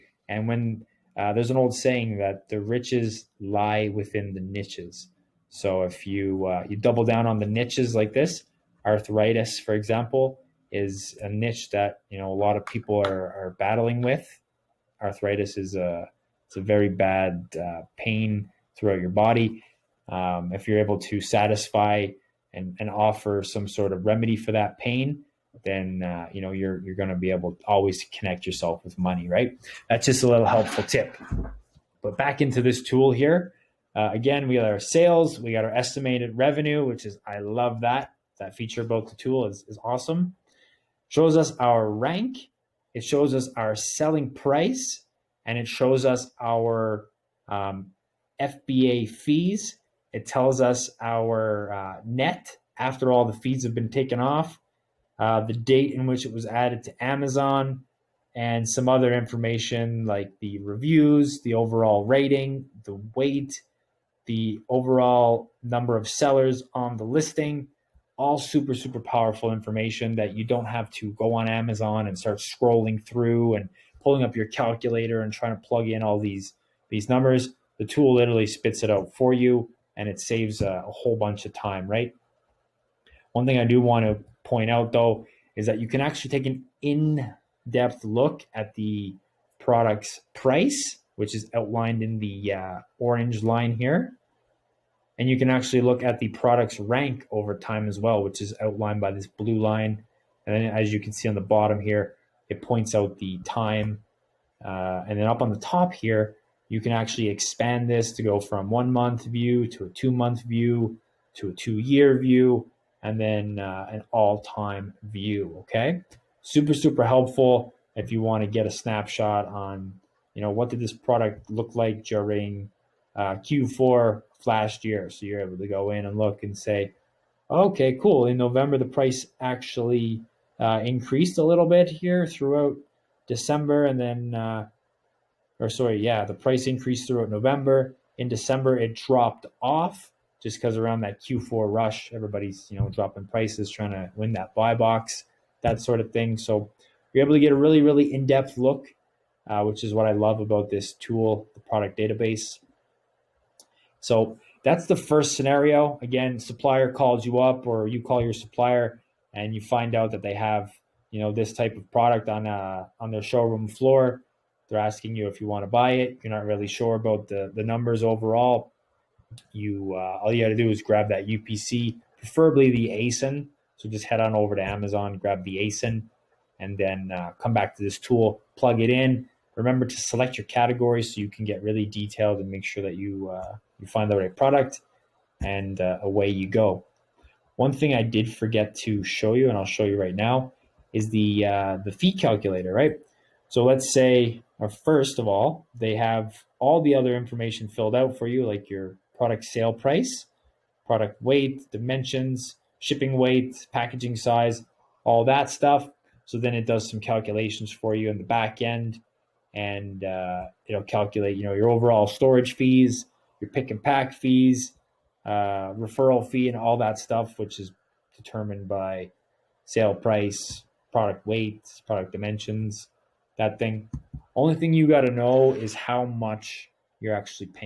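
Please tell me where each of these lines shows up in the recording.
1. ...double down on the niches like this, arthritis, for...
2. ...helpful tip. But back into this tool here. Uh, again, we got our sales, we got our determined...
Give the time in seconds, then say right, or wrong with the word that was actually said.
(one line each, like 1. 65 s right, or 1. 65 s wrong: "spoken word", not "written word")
1. 6 s right
2. 30 s wrong: "estimated", not "determined".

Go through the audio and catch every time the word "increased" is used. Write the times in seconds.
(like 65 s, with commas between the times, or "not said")
130 s, 136 s.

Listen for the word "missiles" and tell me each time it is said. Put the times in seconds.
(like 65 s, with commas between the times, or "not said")
not said.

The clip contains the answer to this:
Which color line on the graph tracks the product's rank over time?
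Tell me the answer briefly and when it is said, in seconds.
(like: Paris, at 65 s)
Blue, at 99 s.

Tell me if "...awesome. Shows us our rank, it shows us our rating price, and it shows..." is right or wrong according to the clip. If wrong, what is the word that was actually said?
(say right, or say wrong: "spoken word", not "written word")
wrong: "selling", not "rating".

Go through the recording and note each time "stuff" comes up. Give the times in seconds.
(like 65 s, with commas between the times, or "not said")
205 s, 216 s.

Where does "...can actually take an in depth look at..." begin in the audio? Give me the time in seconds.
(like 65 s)
85 s.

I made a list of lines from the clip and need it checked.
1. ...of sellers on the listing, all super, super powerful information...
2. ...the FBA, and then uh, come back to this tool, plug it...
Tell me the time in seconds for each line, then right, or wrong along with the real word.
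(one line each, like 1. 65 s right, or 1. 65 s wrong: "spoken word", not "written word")
1. 65 s right
2. 175 s wrong: "ASIN", not "FBA".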